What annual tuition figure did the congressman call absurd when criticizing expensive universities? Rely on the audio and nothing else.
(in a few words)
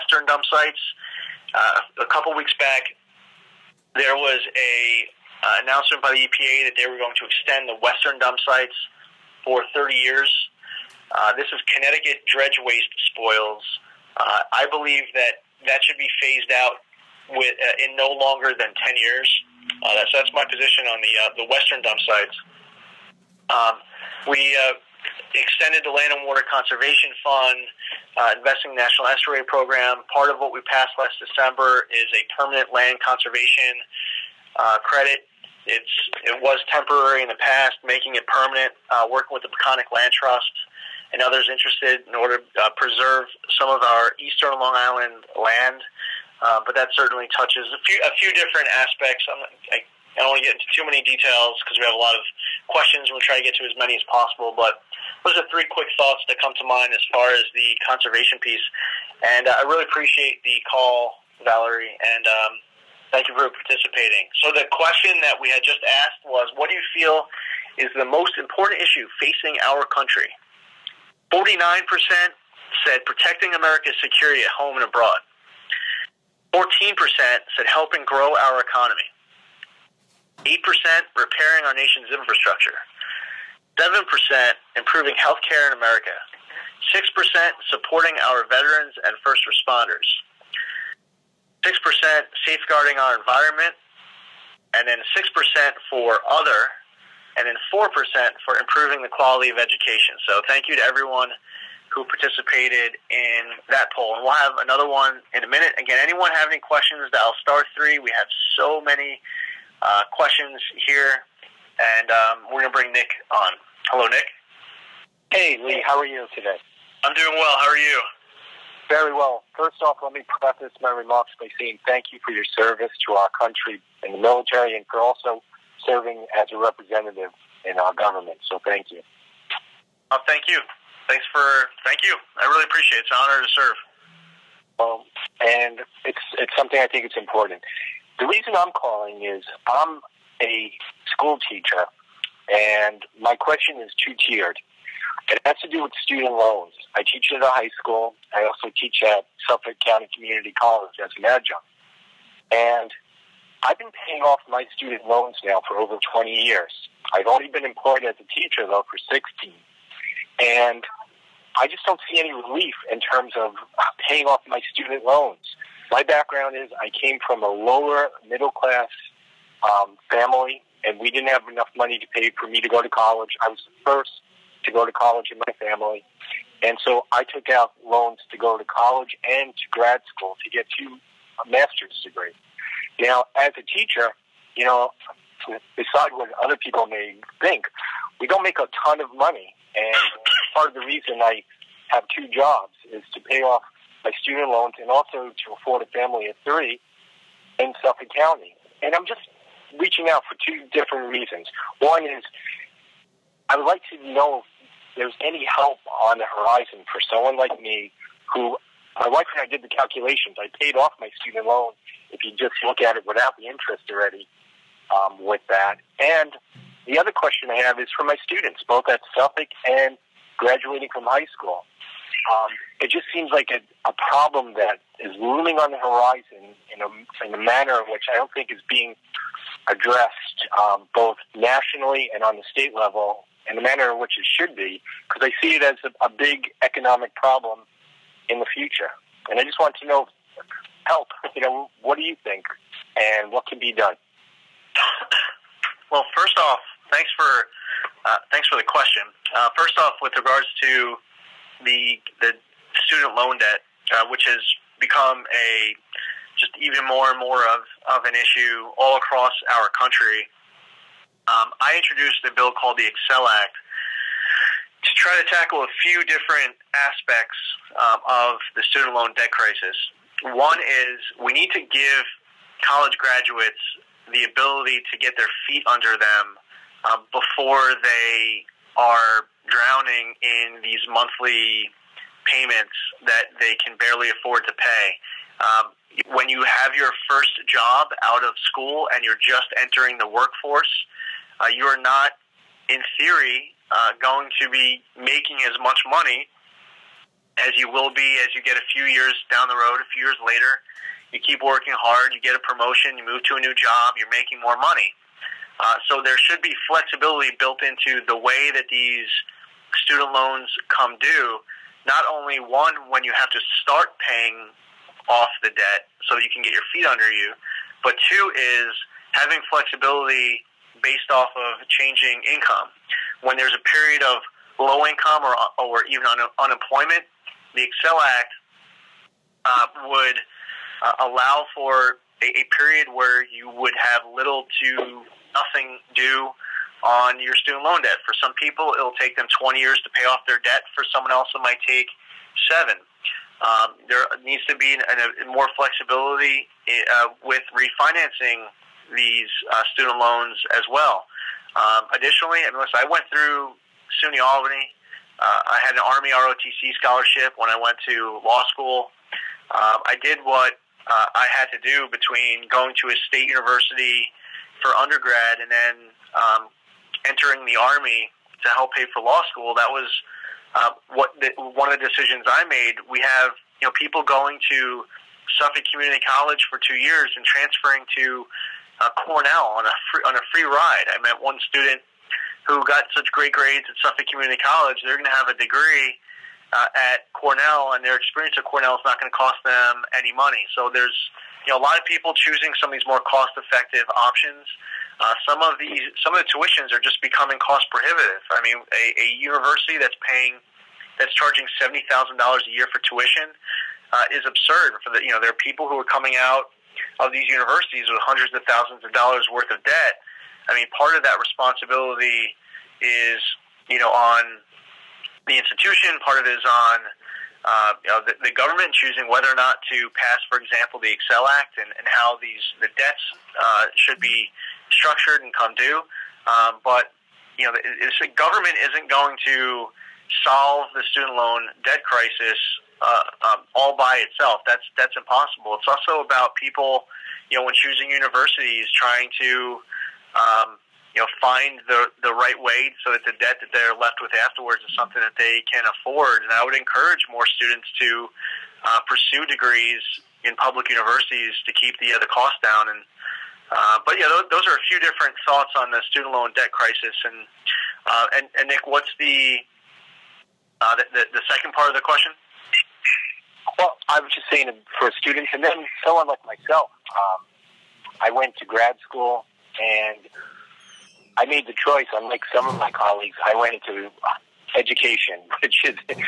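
$70,000.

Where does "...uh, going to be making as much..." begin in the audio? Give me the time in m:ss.
4:53.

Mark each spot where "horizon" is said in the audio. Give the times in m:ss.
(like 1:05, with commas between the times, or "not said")
3:26, 3:45.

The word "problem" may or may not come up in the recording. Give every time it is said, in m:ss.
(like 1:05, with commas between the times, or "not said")
3:44, 3:57.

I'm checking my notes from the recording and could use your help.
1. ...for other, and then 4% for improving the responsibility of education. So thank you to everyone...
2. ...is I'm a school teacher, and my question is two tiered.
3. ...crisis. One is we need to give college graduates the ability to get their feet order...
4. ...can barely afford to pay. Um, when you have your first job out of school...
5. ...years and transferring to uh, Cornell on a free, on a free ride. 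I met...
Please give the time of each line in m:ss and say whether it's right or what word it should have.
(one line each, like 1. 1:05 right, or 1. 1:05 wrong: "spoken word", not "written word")
1. 1:35 wrong: "quality", not "responsibility"
2. 2:19 right
3. 4:29 wrong: "under", not "order"
4. 4:43 right
5. 6:16 right.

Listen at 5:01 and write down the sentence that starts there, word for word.
You keep working hard, you get a promotion, you move to a new job, you're making more money.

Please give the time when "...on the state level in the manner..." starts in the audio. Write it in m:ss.
3:52.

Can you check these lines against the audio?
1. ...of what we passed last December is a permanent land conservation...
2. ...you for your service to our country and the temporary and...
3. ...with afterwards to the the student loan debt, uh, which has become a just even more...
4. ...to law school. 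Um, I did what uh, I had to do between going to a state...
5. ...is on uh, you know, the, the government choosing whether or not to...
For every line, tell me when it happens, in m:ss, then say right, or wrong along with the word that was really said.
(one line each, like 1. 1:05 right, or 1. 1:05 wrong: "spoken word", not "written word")
1. 0:30 right
2. 2:02 wrong: "military", not "temporary"
3. 4:10 wrong: "regards", not "afterwards"
4. 5:57 right
5. 6:56 right.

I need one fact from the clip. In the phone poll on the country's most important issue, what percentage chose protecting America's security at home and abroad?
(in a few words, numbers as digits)
49%.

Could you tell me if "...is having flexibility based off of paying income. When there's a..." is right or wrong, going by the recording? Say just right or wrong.
wrong.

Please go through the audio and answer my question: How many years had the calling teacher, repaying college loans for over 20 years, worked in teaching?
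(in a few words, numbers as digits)
16.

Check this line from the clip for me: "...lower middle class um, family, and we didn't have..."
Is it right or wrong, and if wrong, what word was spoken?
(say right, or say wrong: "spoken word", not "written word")
right.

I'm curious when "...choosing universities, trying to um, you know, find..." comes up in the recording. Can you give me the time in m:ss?
7:17.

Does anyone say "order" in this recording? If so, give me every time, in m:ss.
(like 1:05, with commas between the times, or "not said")
0:42.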